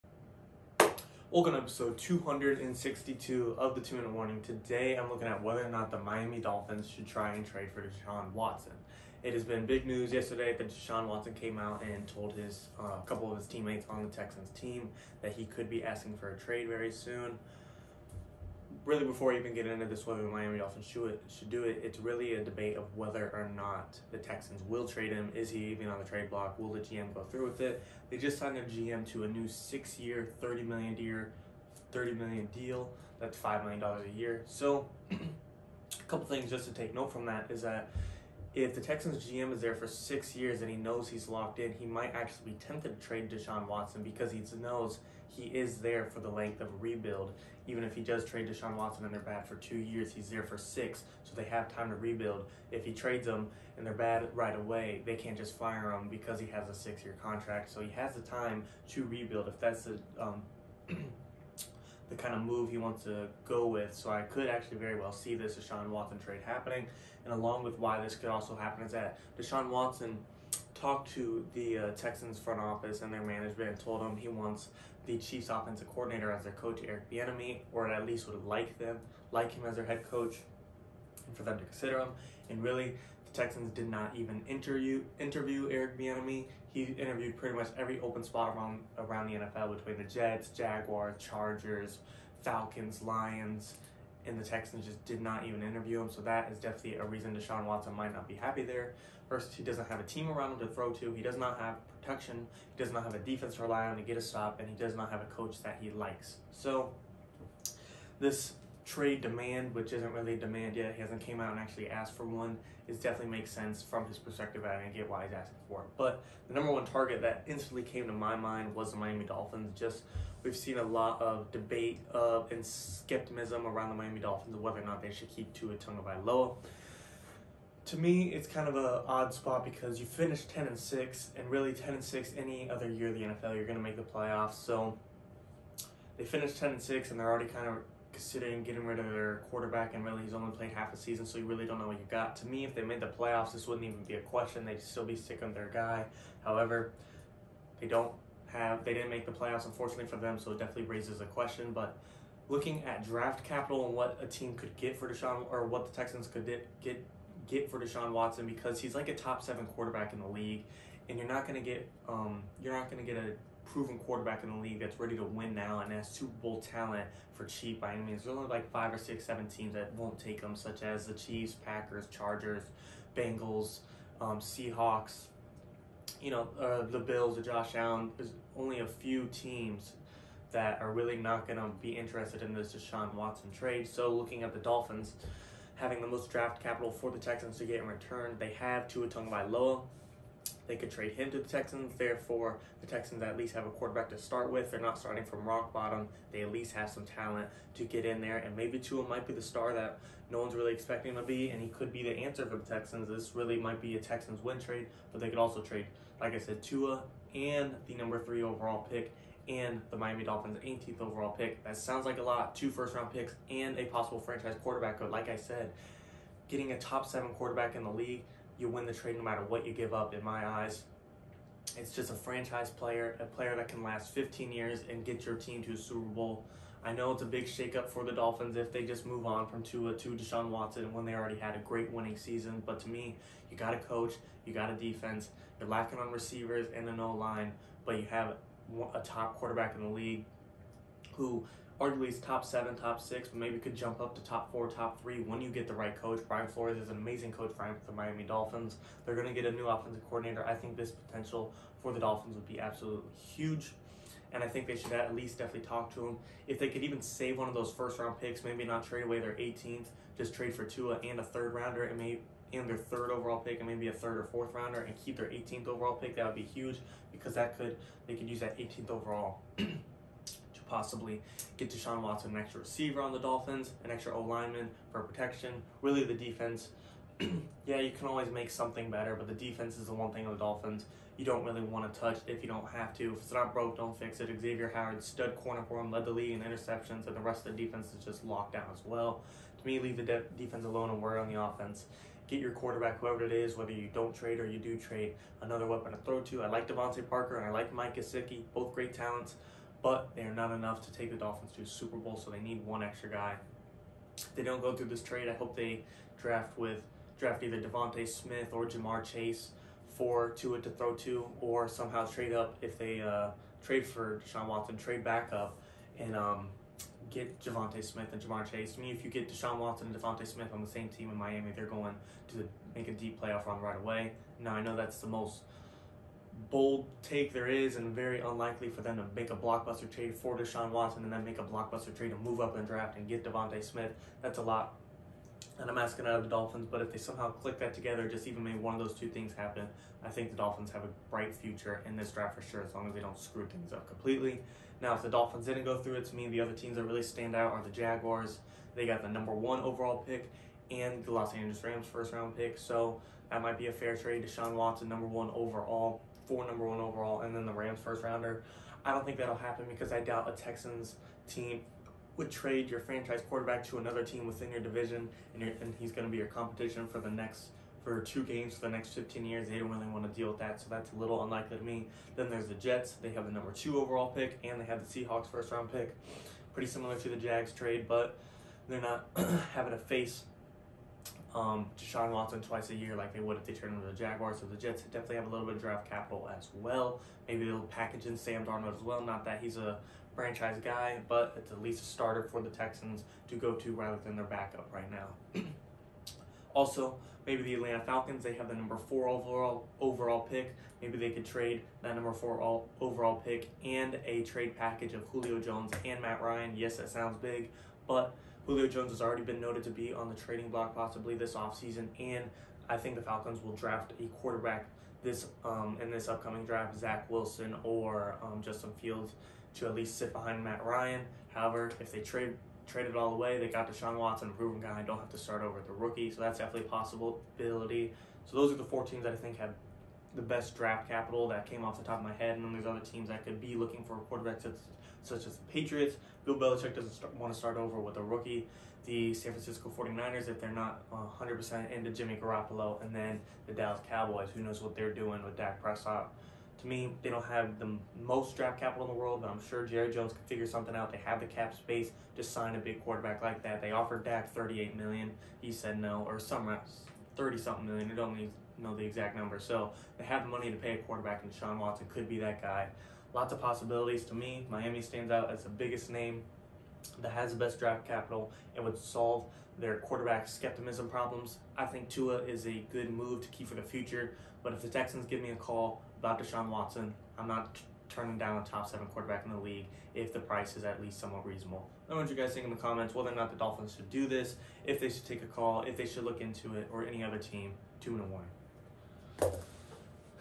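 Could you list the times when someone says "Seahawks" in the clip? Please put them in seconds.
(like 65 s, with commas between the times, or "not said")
174 s, 375 s.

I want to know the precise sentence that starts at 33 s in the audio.
That's five million dollars a year.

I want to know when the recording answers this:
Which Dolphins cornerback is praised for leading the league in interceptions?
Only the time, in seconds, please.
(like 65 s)
284 s.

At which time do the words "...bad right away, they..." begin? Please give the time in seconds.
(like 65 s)
53 s.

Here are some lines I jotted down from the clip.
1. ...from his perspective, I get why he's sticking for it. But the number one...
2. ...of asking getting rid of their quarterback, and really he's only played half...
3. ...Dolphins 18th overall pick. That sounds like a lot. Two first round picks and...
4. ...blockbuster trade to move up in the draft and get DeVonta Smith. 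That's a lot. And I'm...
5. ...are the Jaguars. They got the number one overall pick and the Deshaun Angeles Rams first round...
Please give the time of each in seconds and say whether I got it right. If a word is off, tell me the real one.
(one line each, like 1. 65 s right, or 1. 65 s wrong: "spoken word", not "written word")
1. 113 s wrong: "asking", not "sticking"
2. 137 s wrong: "considering", not "asking"
3. 210 s right
4. 331 s right
5. 347 s wrong: "Los", not "Deshaun".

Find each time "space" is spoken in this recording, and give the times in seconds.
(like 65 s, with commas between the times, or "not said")
451 s.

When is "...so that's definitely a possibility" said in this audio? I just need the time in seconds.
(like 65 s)
426 s.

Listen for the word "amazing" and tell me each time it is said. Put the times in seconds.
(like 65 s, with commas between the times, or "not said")
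246 s.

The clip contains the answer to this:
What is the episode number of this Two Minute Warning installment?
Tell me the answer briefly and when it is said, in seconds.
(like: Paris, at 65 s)
262, at 1 s.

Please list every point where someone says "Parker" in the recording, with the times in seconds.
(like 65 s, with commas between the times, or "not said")
297 s.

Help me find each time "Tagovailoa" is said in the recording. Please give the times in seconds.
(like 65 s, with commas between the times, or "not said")
125 s, 189 s.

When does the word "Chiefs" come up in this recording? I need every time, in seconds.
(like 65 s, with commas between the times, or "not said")
75 s, 171 s.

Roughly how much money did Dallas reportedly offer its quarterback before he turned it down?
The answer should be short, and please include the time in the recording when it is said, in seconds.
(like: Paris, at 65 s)
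38 million, at 454 s.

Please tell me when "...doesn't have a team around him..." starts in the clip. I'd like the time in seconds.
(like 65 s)
99 s.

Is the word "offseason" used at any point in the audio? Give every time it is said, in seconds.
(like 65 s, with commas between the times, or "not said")
411 s.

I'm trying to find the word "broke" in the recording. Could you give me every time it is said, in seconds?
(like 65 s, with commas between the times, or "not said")
283 s.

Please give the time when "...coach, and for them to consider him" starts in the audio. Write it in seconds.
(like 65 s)
80 s.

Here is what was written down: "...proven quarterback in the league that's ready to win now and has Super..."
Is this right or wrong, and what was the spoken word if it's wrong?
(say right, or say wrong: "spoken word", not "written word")
right.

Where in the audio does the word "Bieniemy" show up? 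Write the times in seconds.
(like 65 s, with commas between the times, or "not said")
77 s, 85 s.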